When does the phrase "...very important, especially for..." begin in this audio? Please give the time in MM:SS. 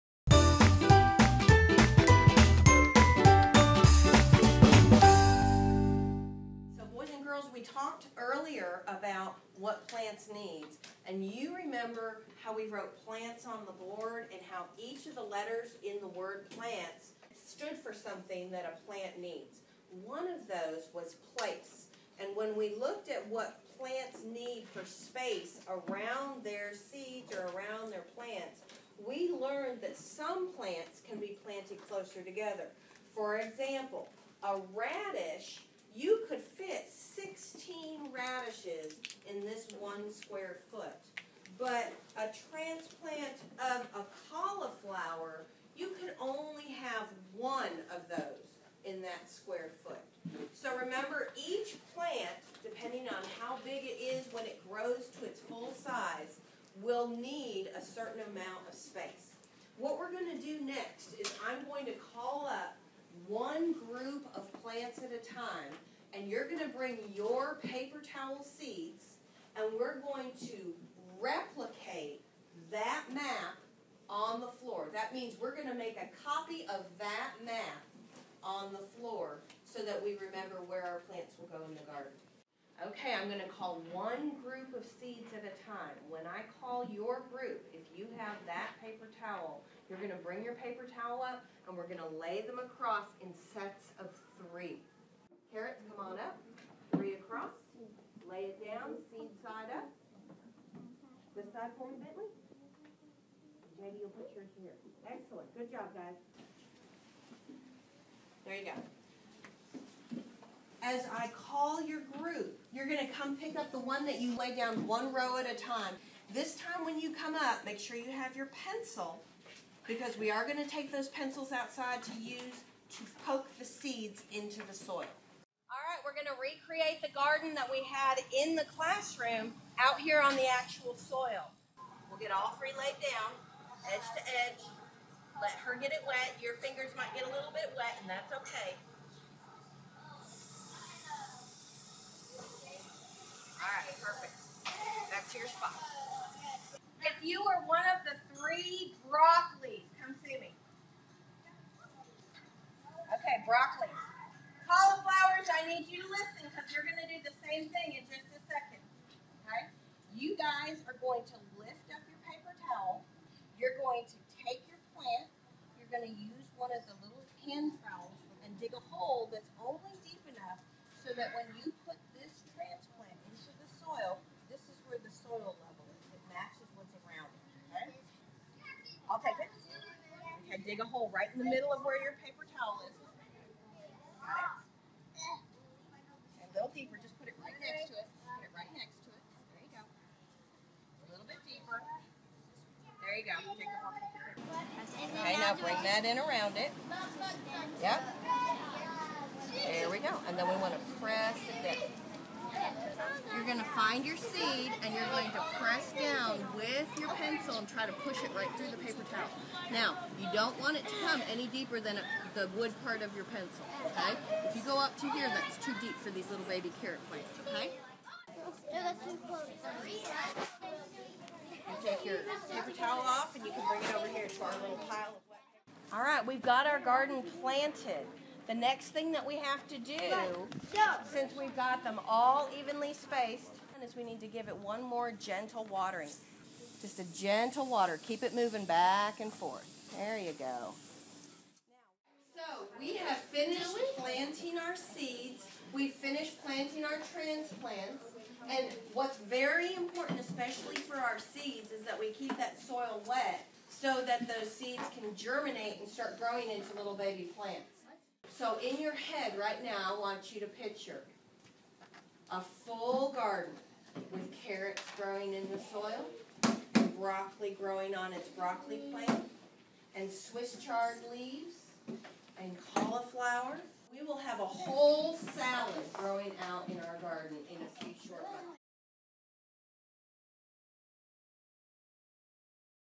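04:09.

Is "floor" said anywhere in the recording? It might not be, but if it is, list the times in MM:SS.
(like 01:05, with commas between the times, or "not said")
01:14, 01:18.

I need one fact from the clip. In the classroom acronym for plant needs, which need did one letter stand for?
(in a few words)
Place.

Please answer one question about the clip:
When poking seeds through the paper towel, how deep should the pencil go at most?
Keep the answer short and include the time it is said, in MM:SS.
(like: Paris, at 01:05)
The wood part, at 03:32.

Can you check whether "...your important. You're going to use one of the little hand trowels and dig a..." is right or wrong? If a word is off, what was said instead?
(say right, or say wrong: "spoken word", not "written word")
wrong: "plant", not "important".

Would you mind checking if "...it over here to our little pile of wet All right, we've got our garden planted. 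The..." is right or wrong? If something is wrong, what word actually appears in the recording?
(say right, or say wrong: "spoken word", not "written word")
right.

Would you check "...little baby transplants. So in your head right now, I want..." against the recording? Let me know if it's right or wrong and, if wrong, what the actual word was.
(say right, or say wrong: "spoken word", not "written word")
wrong: "plants", not "transplants".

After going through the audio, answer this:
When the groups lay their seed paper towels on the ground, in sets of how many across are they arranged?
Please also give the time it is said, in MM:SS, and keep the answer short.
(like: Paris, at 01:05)
3, at 01:33.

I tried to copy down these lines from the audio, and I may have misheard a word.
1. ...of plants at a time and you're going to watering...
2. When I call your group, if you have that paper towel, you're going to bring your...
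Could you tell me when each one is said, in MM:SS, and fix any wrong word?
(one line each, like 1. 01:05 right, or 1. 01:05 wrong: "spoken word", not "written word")
1. 01:04 wrong: "bring", not "watering"
2. 01:26 right.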